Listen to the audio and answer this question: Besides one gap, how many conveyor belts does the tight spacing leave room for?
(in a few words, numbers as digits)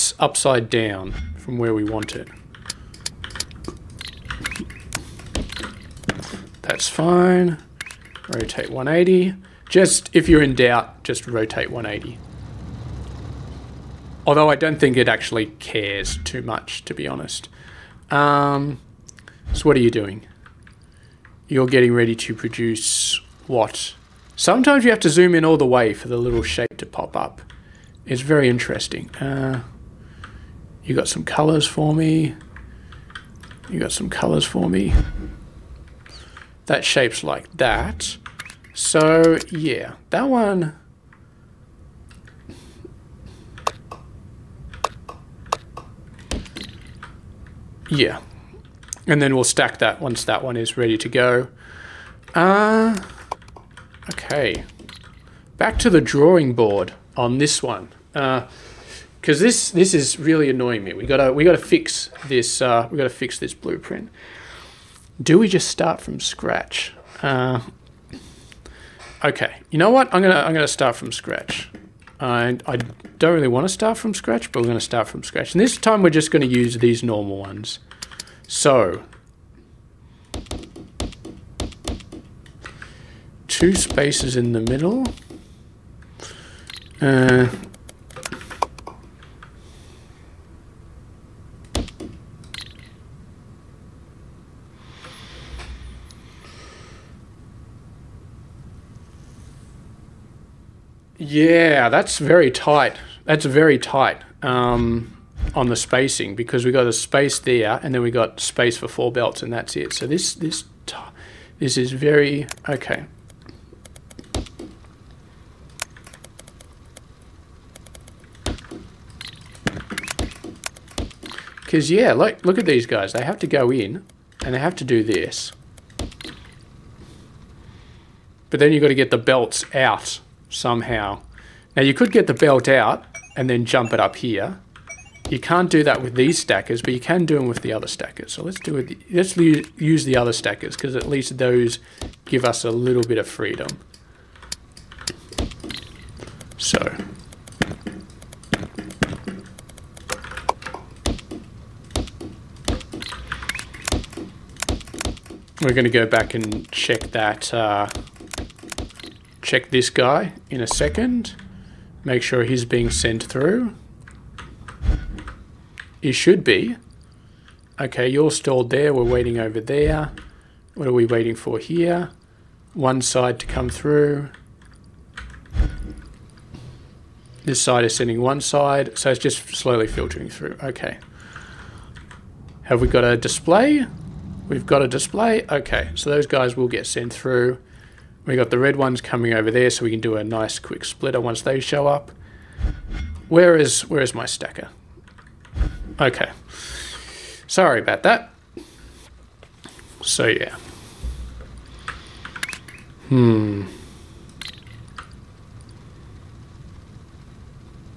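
4.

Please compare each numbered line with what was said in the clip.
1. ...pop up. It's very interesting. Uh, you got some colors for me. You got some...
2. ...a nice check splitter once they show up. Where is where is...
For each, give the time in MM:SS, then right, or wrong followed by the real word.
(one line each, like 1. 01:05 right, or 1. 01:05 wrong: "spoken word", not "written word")
1. 00:26 right
2. 03:10 wrong: "quick", not "check".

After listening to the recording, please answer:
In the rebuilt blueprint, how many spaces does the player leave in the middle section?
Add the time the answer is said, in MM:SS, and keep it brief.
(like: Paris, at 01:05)
2, at 01:23.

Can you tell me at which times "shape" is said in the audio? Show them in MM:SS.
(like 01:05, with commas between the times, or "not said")
00:26, 00:36.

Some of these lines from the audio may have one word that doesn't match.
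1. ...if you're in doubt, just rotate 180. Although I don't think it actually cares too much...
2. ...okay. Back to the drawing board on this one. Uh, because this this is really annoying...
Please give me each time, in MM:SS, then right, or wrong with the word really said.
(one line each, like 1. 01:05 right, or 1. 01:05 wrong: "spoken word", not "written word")
1. 00:10 right
2. 00:54 right.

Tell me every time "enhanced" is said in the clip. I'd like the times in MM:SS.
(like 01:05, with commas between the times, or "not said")
not said.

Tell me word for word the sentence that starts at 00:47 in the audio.
Yeah, and then we'll stack that once that one is ready to go.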